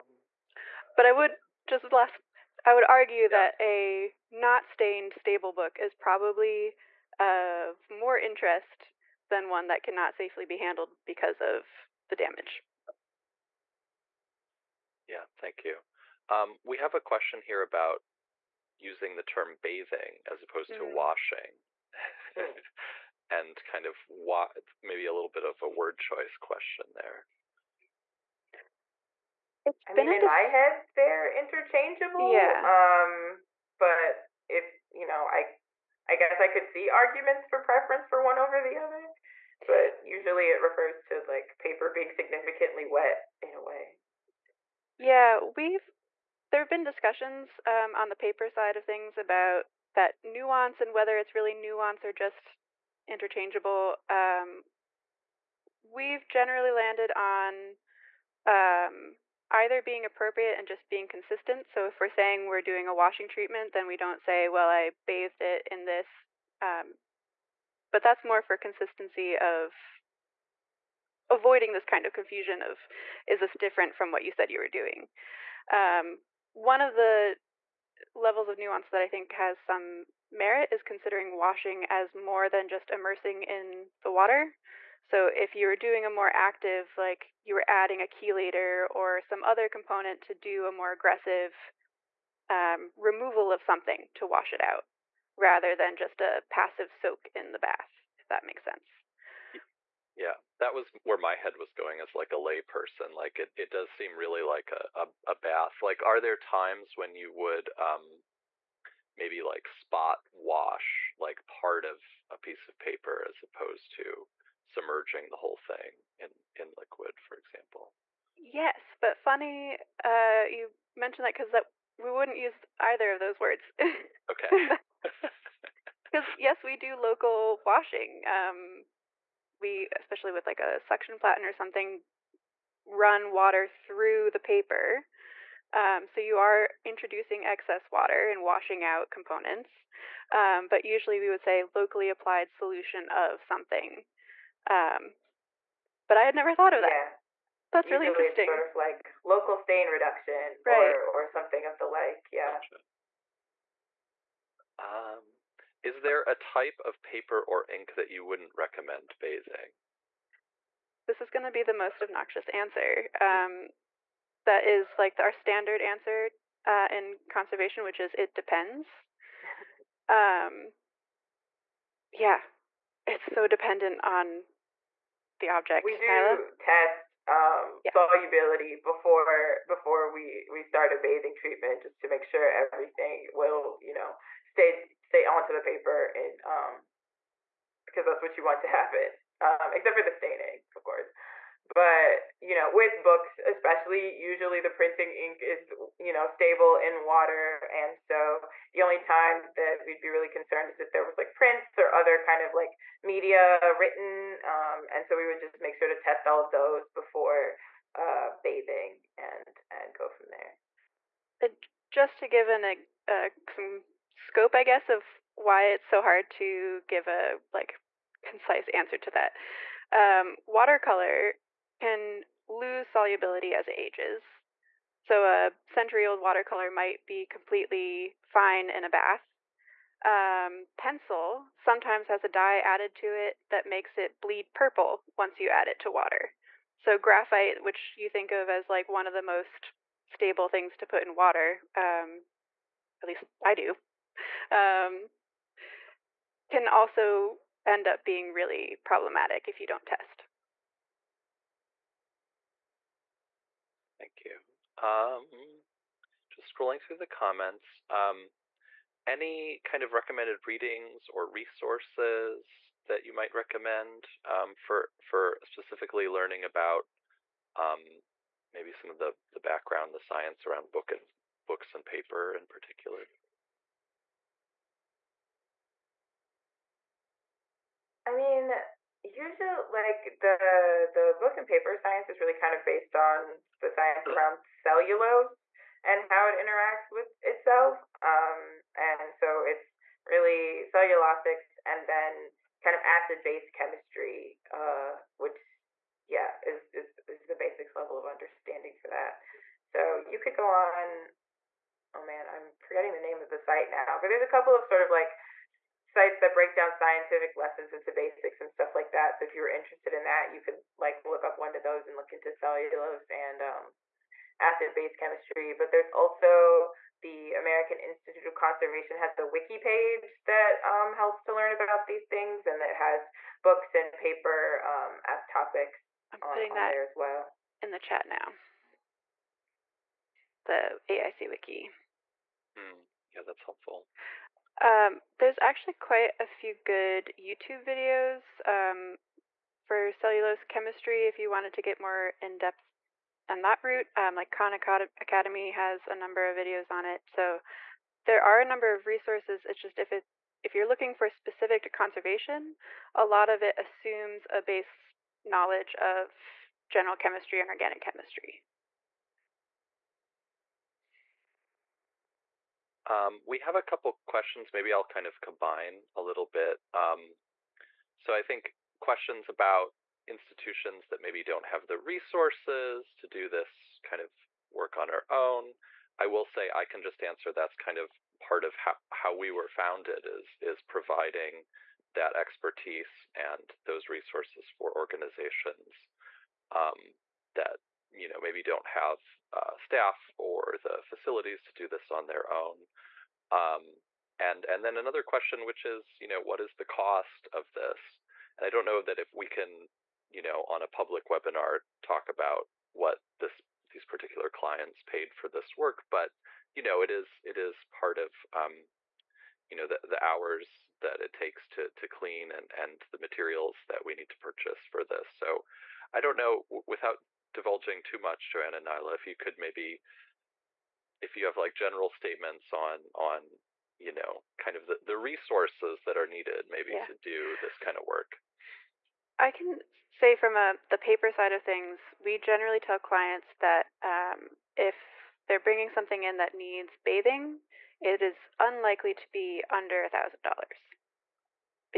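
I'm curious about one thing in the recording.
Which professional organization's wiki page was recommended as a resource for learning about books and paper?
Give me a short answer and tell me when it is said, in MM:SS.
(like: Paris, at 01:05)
American Institute of Conservation, at 05:17.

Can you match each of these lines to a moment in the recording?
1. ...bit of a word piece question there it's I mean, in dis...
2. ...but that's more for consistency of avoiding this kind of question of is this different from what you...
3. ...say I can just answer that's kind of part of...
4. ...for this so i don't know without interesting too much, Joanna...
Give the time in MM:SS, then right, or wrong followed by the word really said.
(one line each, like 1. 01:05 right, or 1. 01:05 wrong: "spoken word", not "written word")
1. 00:25 wrong: "choice", not "piece"
2. 01:07 wrong: "confusion", not "question"
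3. 06:16 right
4. 06:54 wrong: "divulging", not "interesting".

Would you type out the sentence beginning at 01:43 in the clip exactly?
Like it, it does seem really like a, a, a bath.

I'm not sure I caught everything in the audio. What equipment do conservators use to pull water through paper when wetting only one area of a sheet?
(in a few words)
suction platen.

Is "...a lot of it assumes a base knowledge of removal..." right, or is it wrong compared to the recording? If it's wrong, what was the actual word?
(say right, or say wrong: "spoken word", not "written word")
wrong: "general", not "removal".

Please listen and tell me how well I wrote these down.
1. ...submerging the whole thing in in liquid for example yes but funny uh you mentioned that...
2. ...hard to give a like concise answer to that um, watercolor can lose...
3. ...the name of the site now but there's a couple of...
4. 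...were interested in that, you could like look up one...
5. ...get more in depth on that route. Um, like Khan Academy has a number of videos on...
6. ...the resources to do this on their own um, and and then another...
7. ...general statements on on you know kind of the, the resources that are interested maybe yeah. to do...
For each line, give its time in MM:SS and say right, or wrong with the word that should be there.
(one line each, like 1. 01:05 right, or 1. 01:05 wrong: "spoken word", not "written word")
1. 01:54 right
2. 03:36 right
3. 05:02 right
4. 05:09 right
5. 05:41 right
6. 06:30 wrong: "facilities", not "resources"
7. 07:01 wrong: "needed", not "interested".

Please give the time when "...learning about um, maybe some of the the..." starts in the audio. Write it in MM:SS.
04:26.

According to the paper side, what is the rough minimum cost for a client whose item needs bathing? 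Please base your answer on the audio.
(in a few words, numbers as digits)
$1,000.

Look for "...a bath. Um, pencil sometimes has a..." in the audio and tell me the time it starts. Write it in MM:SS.
03:48.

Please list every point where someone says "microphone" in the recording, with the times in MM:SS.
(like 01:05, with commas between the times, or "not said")
not said.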